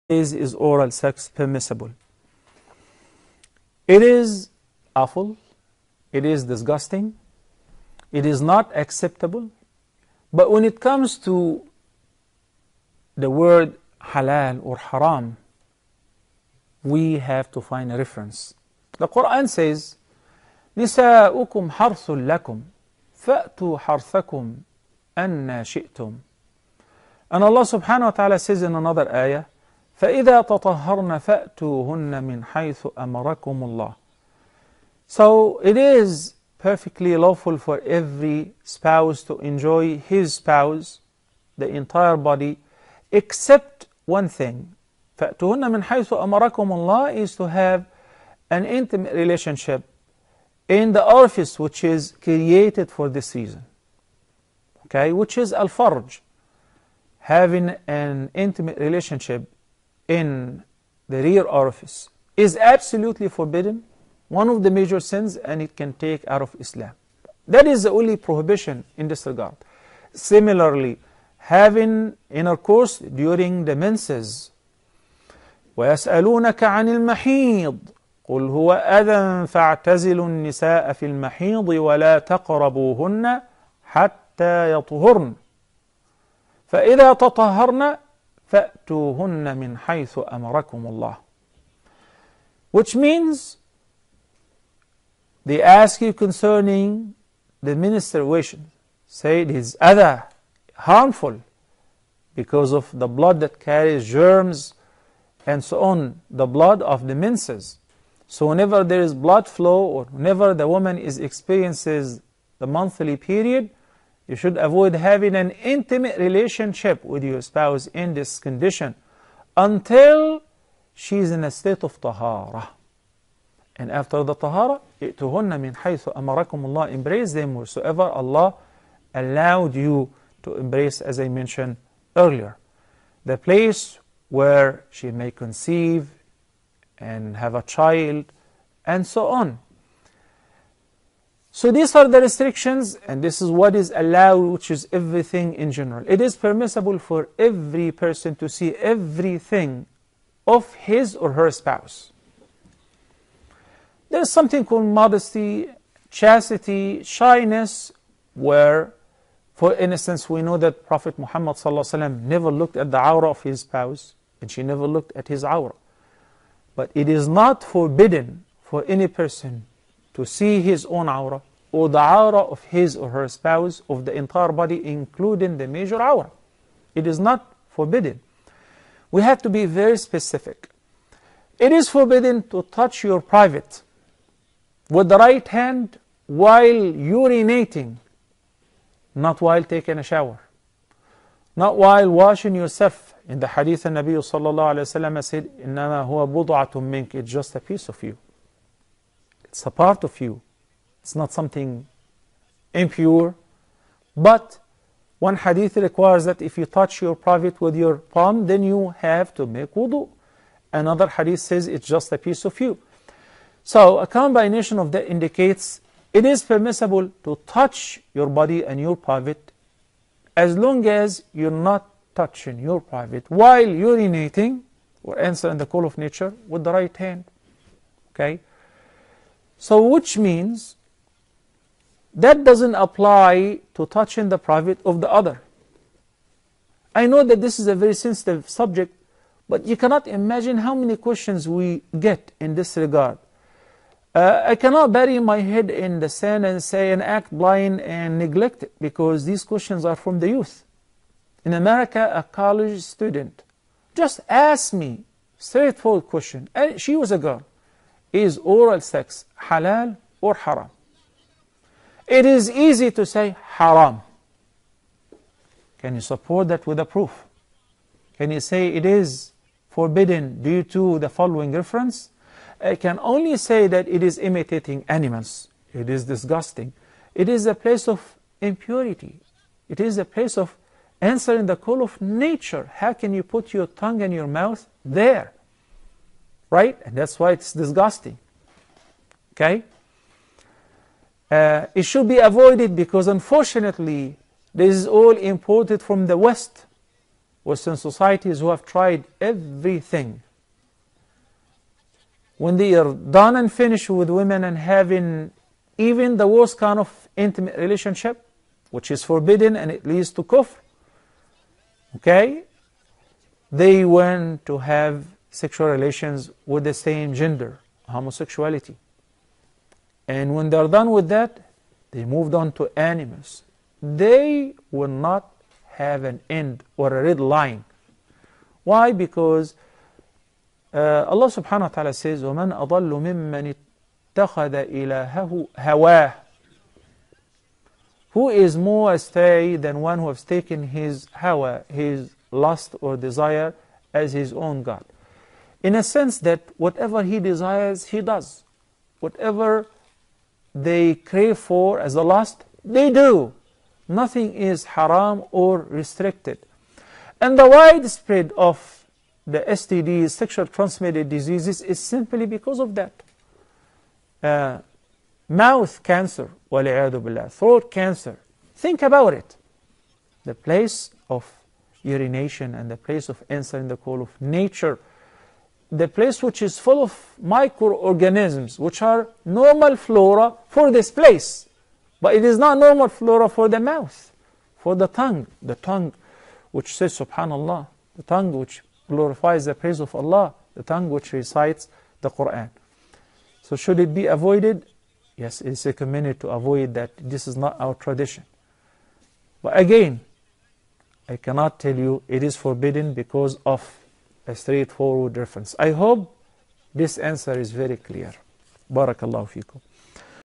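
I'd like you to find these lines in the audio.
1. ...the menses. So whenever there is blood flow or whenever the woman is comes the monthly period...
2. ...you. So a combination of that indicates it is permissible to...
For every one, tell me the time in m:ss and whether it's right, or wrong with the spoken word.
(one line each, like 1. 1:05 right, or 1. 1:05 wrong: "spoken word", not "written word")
1. 1:47 wrong: "experiences", not "comes"
2. 3:32 right.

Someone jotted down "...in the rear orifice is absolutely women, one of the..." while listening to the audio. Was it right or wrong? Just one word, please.
wrong.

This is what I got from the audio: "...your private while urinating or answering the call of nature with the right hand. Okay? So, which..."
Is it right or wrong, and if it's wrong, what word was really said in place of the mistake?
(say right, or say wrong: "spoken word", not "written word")
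right.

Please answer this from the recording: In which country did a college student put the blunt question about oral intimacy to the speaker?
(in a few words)
America.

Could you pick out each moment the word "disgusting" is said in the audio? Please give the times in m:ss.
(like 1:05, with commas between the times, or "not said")
0:06, 4:36, 4:47.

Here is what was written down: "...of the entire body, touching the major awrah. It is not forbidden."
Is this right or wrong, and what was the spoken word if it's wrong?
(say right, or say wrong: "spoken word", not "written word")
wrong: "including", not "touching".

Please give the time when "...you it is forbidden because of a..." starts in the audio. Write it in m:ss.
6:41.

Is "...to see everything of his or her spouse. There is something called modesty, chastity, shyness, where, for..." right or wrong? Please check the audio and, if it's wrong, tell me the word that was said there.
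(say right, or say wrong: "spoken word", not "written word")
right.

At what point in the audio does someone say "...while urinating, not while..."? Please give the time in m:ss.
3:06.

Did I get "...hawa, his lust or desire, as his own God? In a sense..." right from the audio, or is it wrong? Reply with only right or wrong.
right.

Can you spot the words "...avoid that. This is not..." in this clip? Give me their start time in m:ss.
6:36.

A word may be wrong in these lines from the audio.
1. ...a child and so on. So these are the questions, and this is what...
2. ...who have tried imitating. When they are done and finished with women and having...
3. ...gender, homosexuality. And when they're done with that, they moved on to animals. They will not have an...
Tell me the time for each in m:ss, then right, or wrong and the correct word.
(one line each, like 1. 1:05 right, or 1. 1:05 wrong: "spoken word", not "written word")
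1. 2:17 wrong: "restrictions", not "questions"
2. 4:58 wrong: "everything", not "imitating"
3. 5:17 right.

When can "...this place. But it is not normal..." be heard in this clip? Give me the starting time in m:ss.
6:20.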